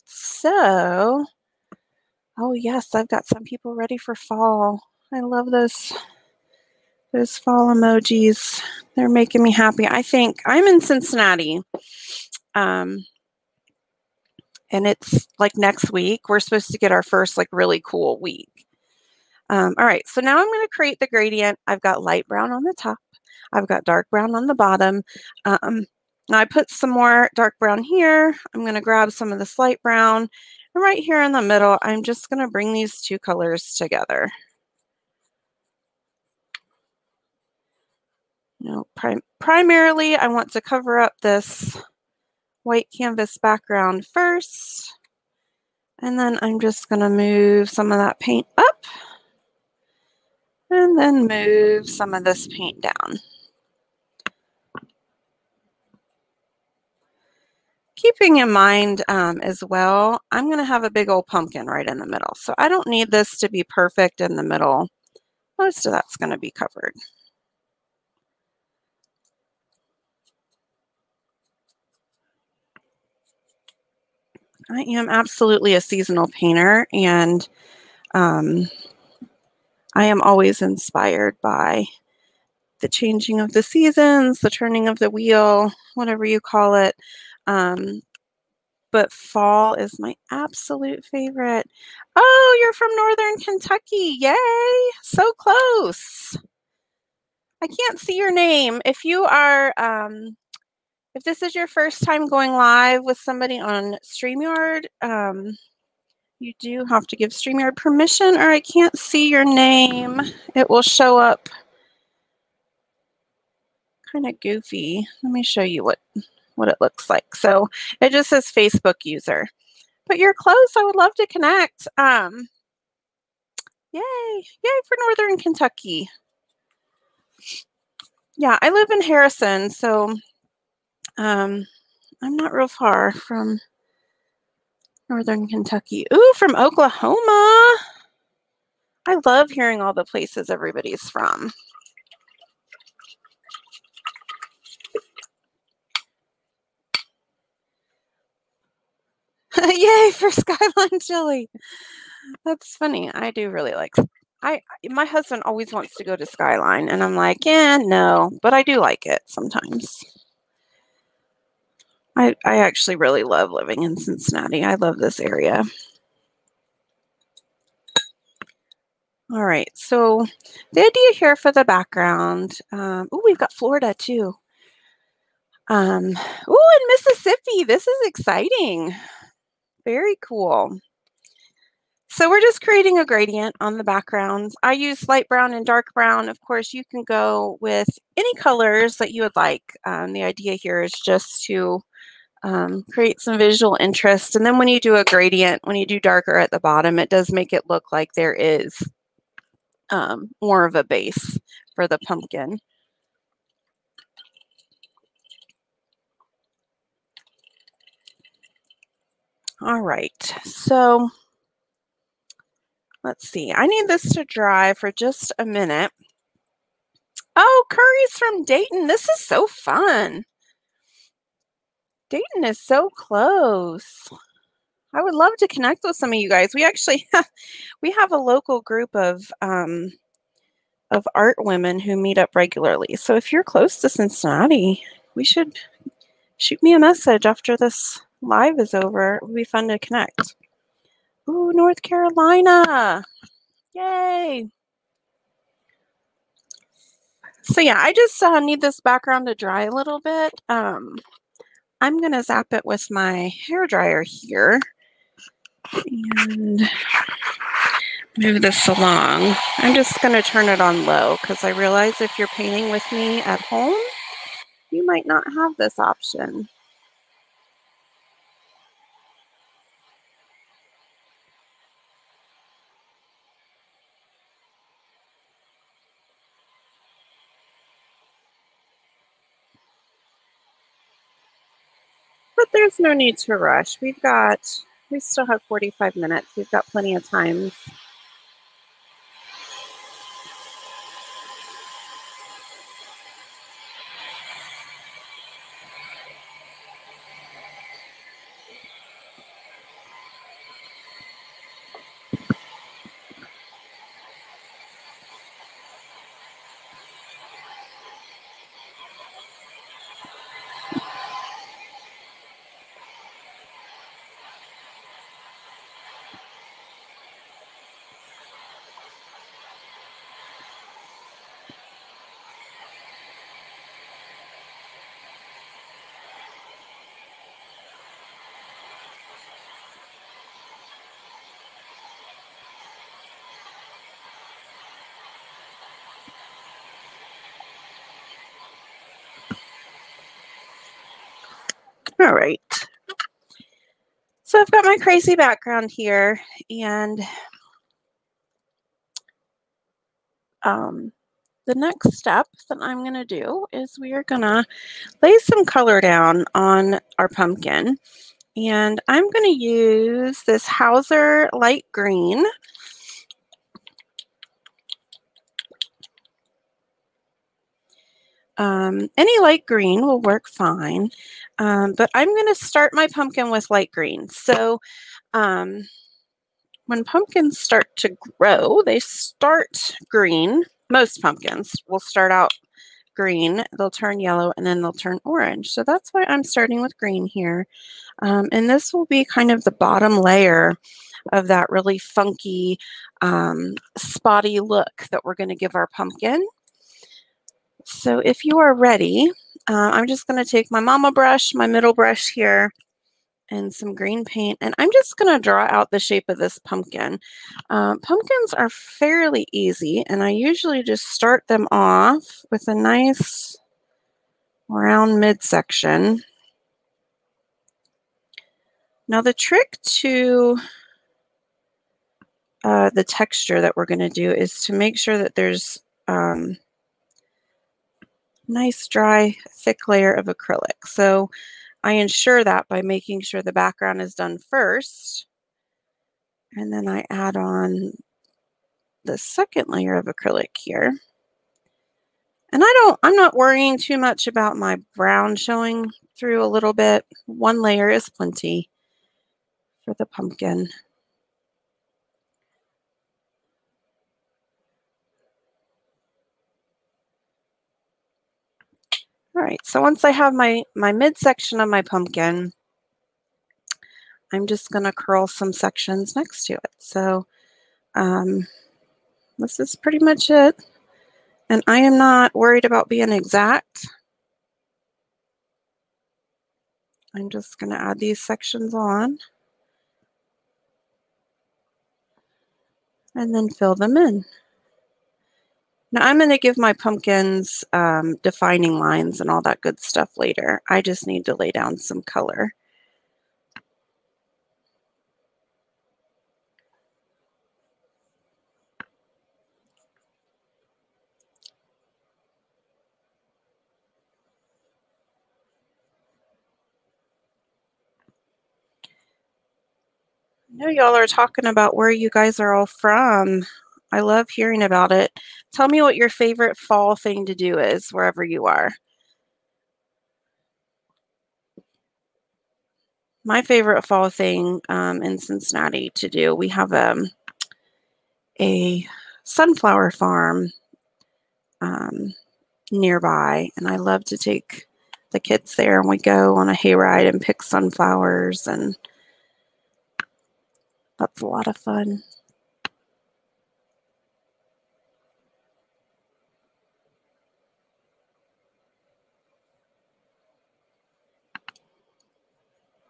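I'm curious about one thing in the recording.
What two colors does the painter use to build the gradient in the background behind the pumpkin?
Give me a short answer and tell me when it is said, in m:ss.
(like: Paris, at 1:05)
Light brown and dark brown, at 3:04.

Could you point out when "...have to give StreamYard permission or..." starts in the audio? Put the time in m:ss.
1:46.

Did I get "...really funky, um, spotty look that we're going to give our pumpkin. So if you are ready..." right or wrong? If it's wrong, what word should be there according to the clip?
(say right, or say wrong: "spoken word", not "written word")
right.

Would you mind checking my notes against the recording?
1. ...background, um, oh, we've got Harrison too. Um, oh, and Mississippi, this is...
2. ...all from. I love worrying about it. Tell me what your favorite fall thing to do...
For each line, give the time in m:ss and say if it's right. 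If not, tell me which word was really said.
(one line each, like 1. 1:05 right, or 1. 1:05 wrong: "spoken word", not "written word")
1. 2:51 wrong: "Florida", not "Harrison"
2. 8:32 wrong: "hearing", not "worrying".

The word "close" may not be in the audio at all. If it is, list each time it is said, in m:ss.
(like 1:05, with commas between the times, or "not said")
1:35, 2:00, 3:42, 3:53.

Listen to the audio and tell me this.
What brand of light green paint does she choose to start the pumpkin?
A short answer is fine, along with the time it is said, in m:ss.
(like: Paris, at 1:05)
Hauser, at 6:00.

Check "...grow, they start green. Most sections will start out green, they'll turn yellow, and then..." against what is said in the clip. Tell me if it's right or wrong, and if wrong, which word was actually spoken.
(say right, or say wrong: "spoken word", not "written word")
wrong: "pumpkins", not "sections".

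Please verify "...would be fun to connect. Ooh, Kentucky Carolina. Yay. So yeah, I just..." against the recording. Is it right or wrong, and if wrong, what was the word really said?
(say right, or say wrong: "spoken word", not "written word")
wrong: "North", not "Kentucky".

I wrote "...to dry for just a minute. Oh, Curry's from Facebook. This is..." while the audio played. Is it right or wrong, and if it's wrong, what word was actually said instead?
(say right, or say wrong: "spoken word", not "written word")
wrong: "Dayton", not "Facebook".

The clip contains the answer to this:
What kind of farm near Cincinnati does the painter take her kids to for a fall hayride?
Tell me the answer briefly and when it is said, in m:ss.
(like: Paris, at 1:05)
Sunflower farm, at 8:49.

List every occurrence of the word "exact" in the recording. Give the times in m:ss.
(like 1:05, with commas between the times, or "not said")
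7:52.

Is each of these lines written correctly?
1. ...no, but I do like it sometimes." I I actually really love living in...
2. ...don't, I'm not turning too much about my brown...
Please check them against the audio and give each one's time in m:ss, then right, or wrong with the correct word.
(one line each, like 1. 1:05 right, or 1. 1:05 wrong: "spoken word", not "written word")
1. 2:37 right
2. 7:22 wrong: "worrying", not "turning".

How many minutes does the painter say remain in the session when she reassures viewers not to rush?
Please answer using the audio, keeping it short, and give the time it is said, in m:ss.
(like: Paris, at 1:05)
45, at 4:45.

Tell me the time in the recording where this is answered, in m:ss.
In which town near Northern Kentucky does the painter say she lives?
2:09.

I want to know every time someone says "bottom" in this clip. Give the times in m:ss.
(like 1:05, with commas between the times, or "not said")
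0:24, 3:16, 6:29.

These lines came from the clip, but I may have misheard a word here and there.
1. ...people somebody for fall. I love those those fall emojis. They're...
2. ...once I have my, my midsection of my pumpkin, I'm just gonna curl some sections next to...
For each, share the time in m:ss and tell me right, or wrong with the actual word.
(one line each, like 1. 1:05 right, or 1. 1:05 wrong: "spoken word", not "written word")
1. 0:03 wrong: "ready", not "somebody"
2. 7:39 right.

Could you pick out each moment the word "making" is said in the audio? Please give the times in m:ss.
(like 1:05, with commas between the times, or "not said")
0:09, 7:12.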